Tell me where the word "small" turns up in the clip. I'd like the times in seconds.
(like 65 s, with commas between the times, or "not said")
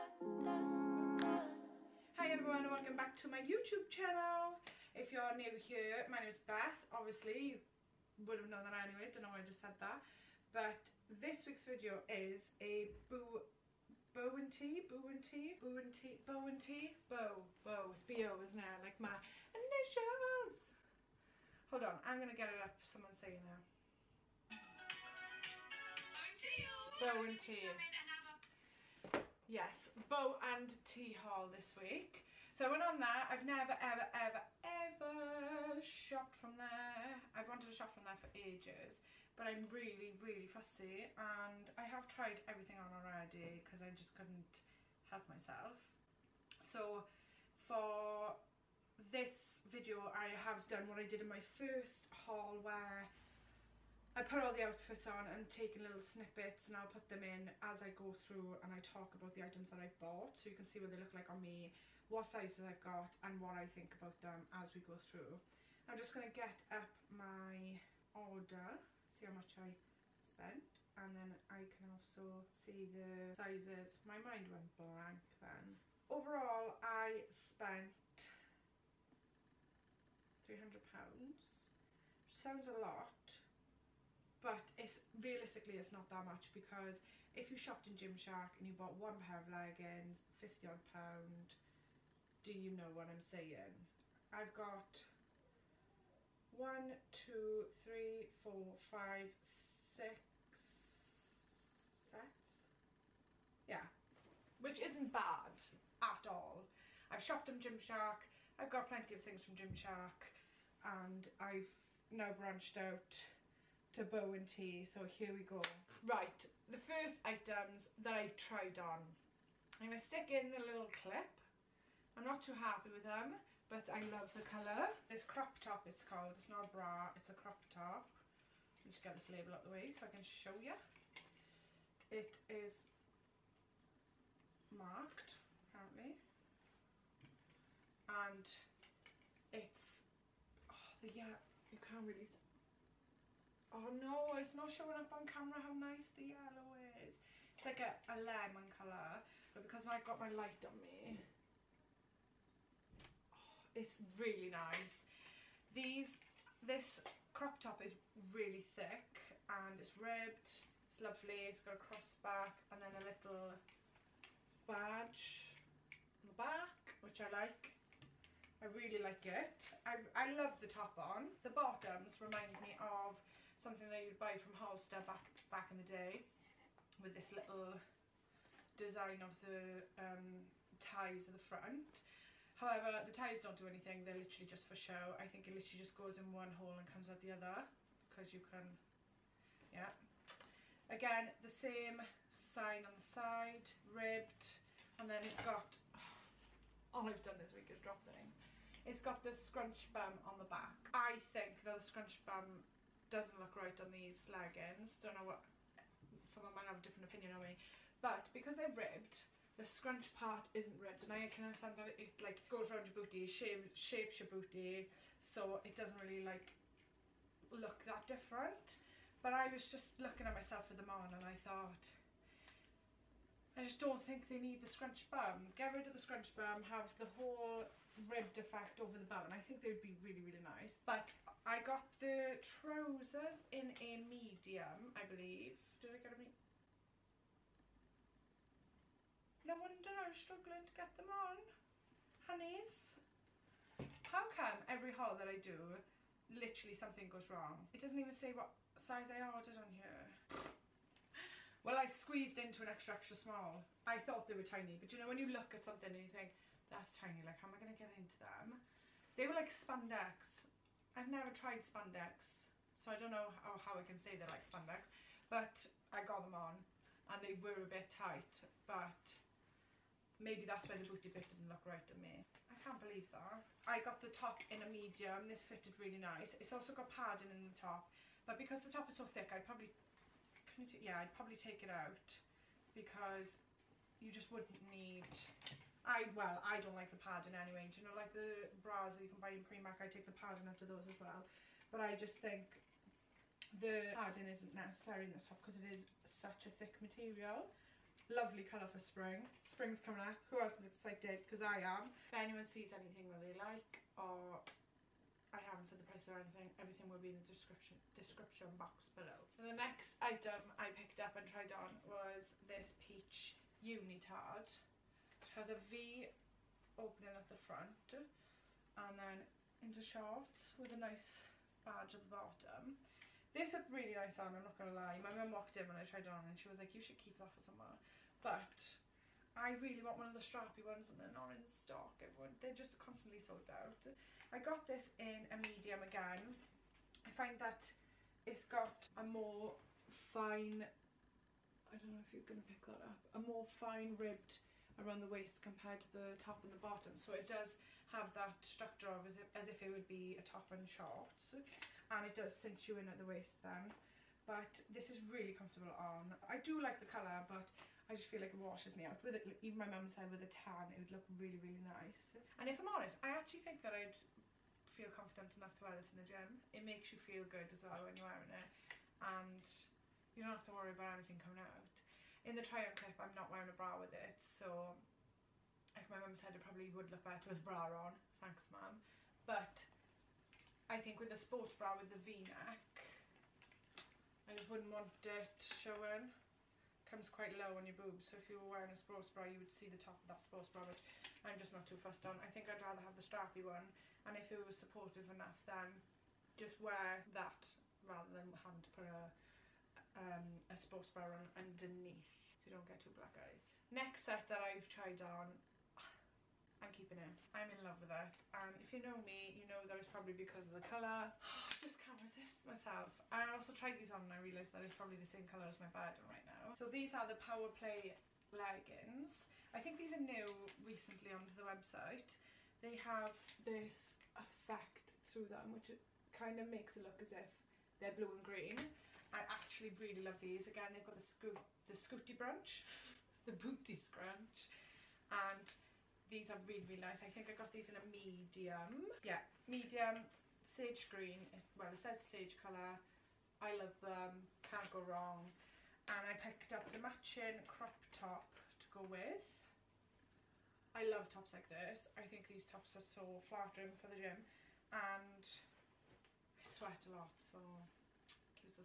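253 s.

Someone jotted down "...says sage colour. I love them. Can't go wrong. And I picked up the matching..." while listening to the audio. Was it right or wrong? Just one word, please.
right.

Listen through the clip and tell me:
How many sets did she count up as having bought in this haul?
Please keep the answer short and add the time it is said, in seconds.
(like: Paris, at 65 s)
6, at 99 s.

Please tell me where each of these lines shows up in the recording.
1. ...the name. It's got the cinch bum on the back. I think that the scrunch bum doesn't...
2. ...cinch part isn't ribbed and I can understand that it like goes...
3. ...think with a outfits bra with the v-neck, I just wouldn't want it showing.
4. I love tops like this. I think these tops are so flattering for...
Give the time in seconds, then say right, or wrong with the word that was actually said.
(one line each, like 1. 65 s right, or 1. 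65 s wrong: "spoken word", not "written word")
1. 198 s wrong: "scrunch", not "cinch"
2. 209 s wrong: "scrunch", not "cinch"
3. 380 s wrong: "sports", not "outfits"
4. 450 s right.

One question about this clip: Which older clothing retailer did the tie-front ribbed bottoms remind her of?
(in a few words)
Hollister.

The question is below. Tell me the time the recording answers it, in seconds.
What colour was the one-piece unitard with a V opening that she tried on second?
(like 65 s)
312 s.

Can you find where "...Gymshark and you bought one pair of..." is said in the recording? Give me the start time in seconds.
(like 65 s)
87 s.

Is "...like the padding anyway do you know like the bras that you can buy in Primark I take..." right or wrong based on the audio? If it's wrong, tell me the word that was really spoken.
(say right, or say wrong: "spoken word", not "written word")
right.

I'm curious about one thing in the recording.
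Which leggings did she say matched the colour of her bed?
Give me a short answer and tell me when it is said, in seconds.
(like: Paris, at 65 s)
Power Play, at 417 s.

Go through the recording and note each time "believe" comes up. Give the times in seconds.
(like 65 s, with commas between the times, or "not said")
235 s, 272 s.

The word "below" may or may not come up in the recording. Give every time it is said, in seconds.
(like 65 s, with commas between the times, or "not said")
308 s.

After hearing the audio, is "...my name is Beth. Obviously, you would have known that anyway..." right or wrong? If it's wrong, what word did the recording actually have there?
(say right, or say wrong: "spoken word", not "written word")
right.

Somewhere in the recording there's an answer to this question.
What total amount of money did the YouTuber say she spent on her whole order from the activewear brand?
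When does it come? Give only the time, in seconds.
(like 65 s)
80 s.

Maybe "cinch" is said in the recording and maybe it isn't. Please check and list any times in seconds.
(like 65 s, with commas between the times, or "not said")
352 s.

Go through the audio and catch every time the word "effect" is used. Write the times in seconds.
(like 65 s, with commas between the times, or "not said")
228 s, 424 s.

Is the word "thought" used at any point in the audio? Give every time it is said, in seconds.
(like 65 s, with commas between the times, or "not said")
221 s, 253 s.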